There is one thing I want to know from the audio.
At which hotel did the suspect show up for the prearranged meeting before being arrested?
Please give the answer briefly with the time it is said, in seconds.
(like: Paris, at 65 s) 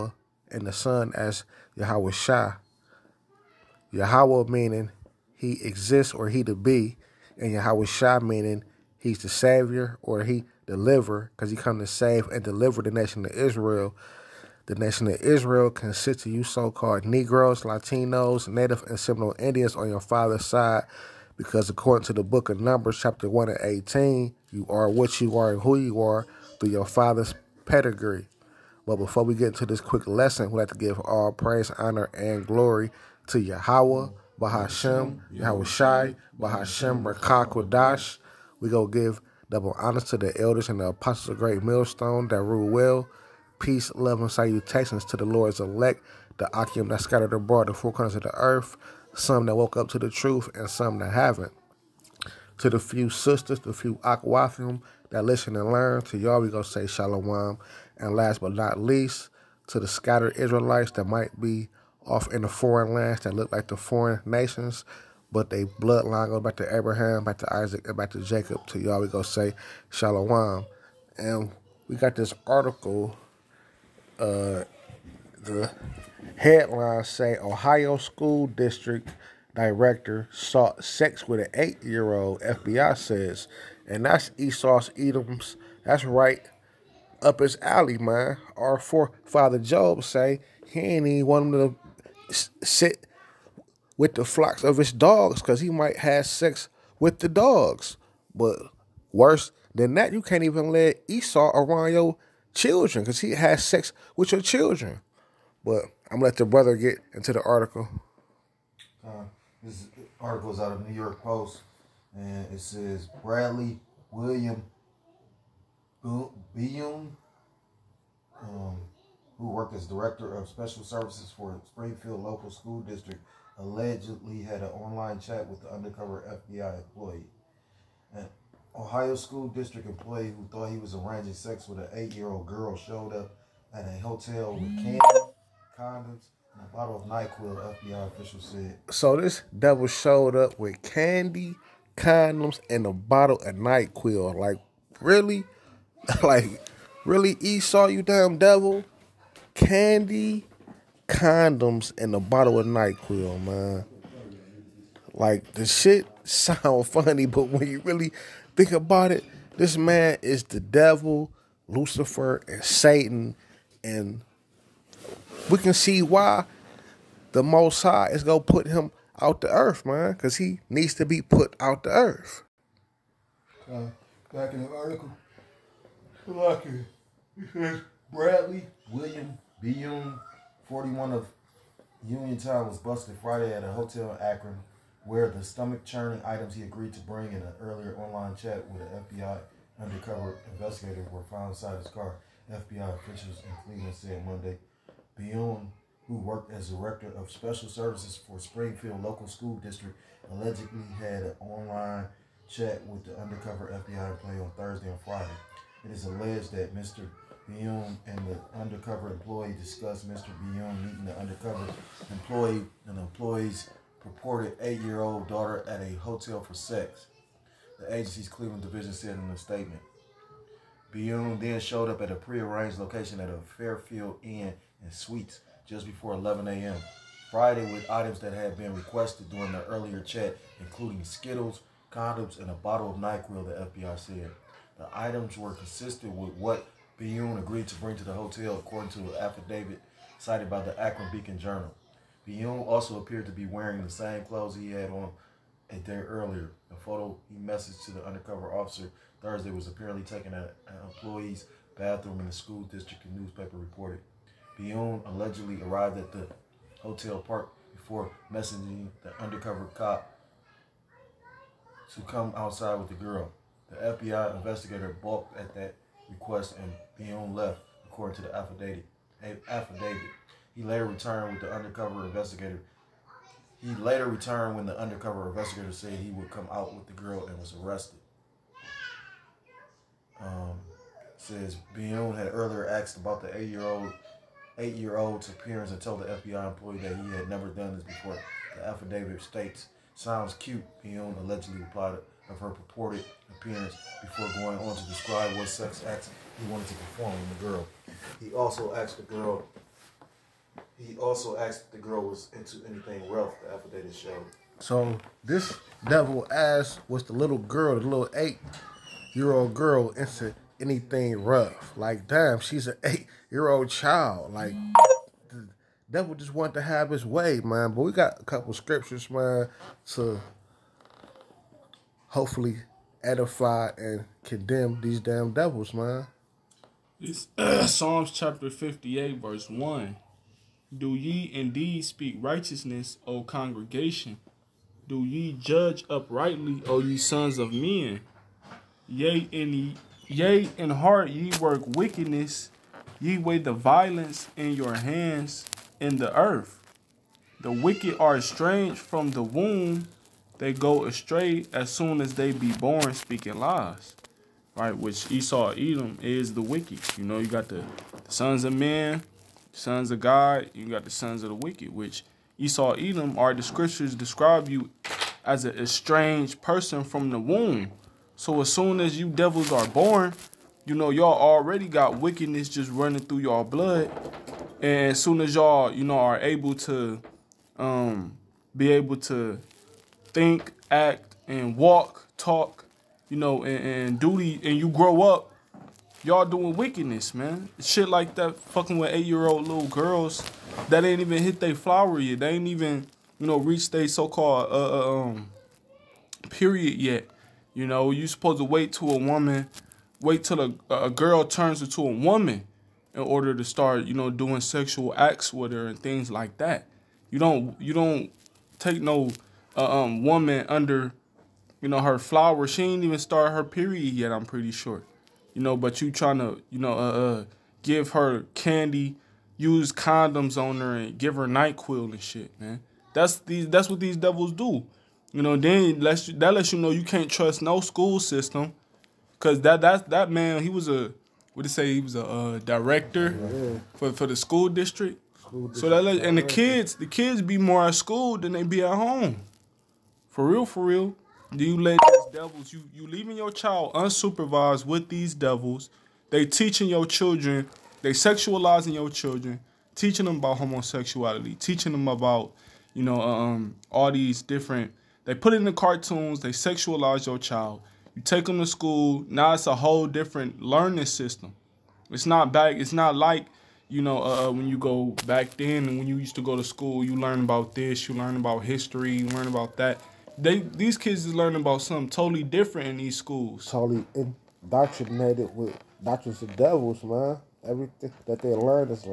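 Fairfield Inn and Suites, at 223 s.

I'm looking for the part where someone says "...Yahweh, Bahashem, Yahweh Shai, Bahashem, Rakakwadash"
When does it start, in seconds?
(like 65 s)
33 s.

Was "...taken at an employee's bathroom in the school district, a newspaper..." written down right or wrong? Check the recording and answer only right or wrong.
right.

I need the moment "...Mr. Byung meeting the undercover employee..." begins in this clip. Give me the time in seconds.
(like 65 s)
210 s.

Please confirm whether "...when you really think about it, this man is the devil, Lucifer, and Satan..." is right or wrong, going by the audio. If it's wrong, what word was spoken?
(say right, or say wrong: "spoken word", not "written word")
right.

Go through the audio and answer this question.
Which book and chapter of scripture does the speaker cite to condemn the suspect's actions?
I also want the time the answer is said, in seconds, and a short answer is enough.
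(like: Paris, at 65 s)
Psalms 58, at 327 s.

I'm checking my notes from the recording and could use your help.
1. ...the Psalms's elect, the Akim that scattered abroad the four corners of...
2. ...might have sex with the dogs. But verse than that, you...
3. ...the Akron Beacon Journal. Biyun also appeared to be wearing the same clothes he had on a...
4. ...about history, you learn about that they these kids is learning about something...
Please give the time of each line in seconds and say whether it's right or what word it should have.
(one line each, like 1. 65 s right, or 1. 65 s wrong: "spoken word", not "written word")
1. 45 s wrong: "Lord", not "Psalms"
2. 95 s wrong: "worse", not "verse"
3. 240 s right
4. 468 s right.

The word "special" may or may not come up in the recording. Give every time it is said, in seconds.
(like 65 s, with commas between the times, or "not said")
120 s, 197 s.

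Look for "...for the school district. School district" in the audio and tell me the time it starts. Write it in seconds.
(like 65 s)
433 s.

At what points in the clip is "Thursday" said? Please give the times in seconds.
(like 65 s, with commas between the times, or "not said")
204 s, 249 s.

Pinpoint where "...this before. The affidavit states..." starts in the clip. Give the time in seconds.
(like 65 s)
287 s.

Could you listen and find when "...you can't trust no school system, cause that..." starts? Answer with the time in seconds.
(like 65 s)
426 s.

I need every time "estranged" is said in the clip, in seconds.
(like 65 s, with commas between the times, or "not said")
348 s, 365 s.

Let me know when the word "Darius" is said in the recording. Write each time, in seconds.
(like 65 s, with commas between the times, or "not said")
not said.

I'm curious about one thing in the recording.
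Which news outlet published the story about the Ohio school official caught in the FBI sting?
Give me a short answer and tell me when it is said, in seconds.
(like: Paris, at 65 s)
New York Post, at 110 s.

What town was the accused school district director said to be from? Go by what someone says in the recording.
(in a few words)
Uniontown.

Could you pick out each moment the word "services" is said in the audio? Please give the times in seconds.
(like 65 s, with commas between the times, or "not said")
120 s, 197 s.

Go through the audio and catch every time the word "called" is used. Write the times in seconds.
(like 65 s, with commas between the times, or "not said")
16 s, 394 s.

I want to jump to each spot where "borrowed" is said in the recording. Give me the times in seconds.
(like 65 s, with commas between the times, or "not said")
not said.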